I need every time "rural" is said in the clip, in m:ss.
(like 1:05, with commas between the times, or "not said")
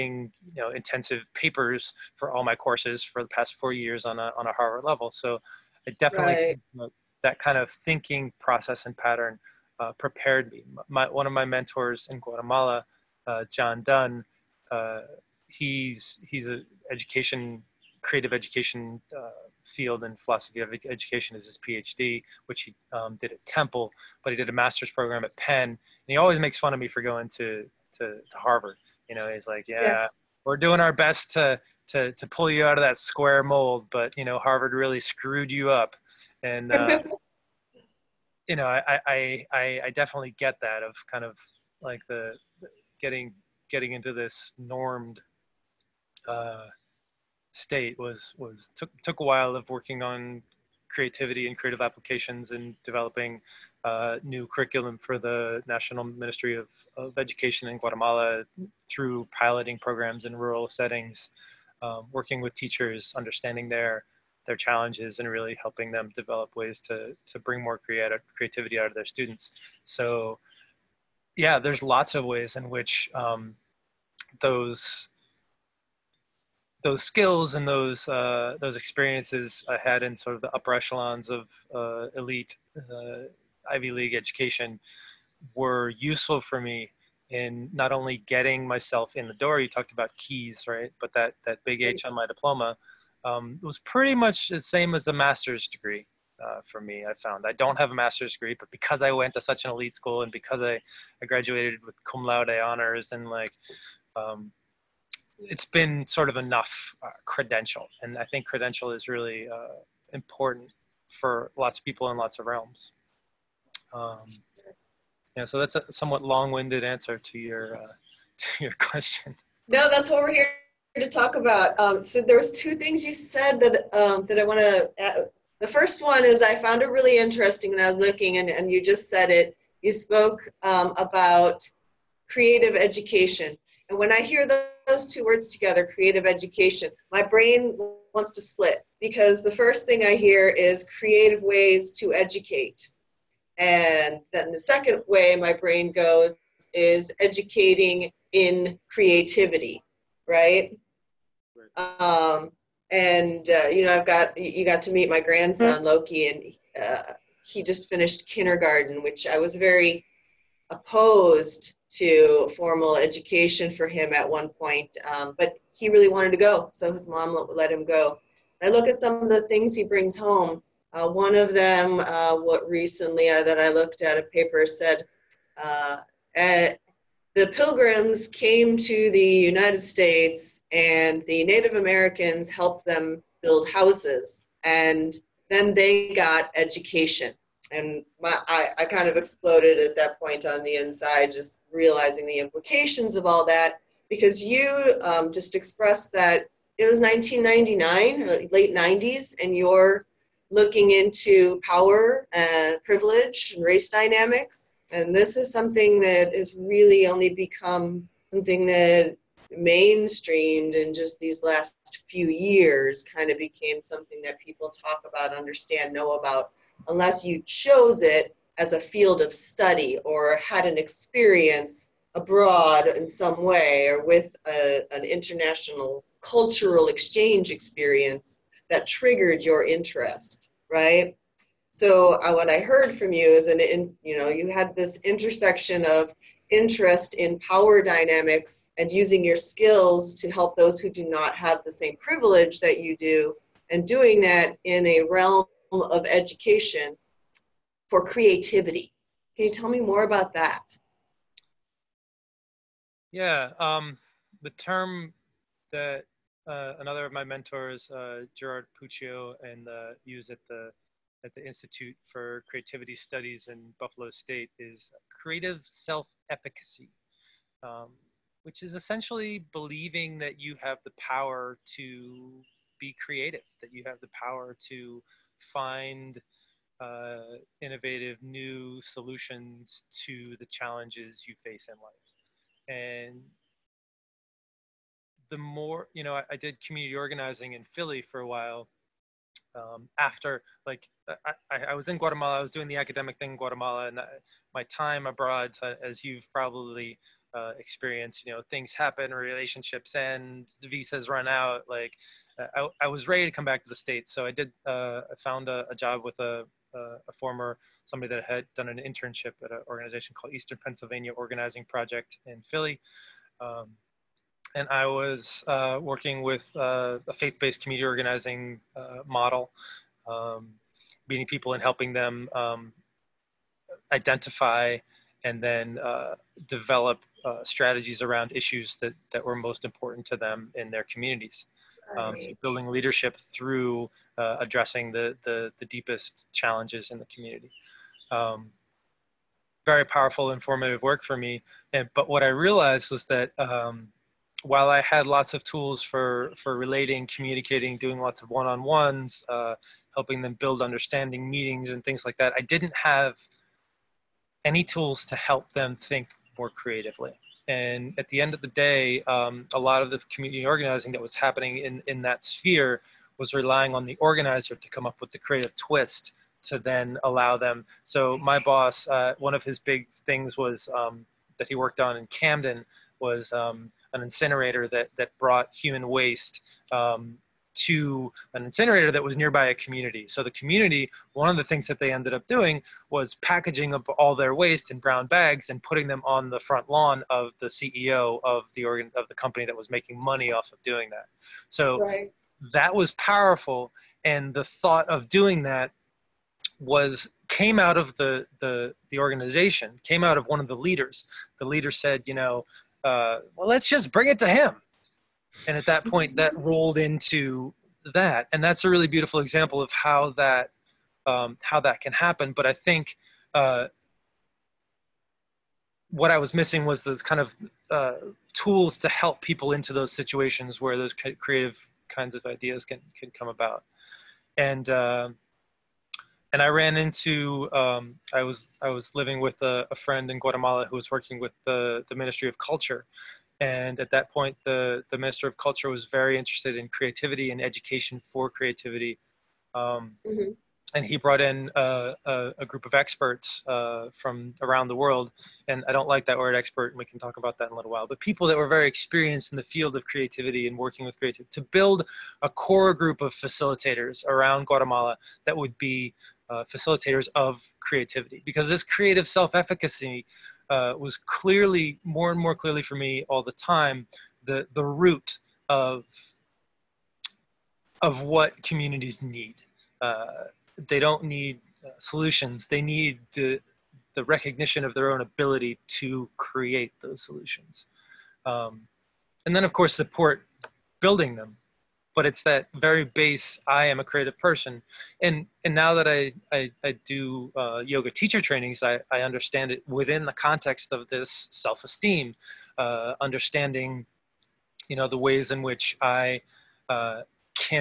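1:00.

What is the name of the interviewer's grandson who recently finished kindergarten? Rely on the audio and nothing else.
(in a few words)
Loki.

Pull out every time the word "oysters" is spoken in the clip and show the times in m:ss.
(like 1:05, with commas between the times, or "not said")
not said.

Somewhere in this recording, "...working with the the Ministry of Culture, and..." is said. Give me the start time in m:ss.
7:10.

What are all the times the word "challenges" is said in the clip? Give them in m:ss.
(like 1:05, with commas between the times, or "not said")
1:04, 4:40, 5:36.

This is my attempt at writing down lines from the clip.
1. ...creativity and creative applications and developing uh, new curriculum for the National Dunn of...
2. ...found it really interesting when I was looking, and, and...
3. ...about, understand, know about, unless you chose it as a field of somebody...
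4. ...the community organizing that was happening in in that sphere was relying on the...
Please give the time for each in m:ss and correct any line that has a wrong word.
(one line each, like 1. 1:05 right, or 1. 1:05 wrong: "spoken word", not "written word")
1. 0:50 wrong: "Ministry", not "Dunn"
2. 2:06 right
3. 3:35 wrong: "study", not "somebody"
4. 5:59 right.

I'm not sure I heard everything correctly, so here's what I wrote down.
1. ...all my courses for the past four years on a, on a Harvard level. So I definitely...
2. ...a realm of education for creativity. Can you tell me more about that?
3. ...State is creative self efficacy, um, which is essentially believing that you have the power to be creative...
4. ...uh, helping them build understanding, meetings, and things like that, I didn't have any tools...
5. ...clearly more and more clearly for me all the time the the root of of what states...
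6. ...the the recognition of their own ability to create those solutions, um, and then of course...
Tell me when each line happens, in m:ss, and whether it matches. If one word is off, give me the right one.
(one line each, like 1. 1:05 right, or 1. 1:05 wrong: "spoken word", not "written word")
1. 0:02 right
2. 4:04 right
3. 4:24 right
4. 5:49 right
5. 7:40 wrong: "communities", not "states"
6. 7:53 right.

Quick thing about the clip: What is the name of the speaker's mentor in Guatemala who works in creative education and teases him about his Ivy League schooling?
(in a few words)
John Dunn.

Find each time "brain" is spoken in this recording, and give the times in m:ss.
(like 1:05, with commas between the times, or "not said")
2:17, 2:25.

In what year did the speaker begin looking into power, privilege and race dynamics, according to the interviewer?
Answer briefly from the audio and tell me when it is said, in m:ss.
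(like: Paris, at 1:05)
1999, at 3:16.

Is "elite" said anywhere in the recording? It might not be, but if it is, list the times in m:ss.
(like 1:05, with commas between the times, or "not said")
1:22, 1:39.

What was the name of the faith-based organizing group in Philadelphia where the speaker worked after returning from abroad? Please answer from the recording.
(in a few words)
Eastern Pennsylvania Organizing Project.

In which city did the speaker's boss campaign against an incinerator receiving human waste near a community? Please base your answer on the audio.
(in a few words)
Camden.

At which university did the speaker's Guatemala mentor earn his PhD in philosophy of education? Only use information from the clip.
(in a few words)
Temple.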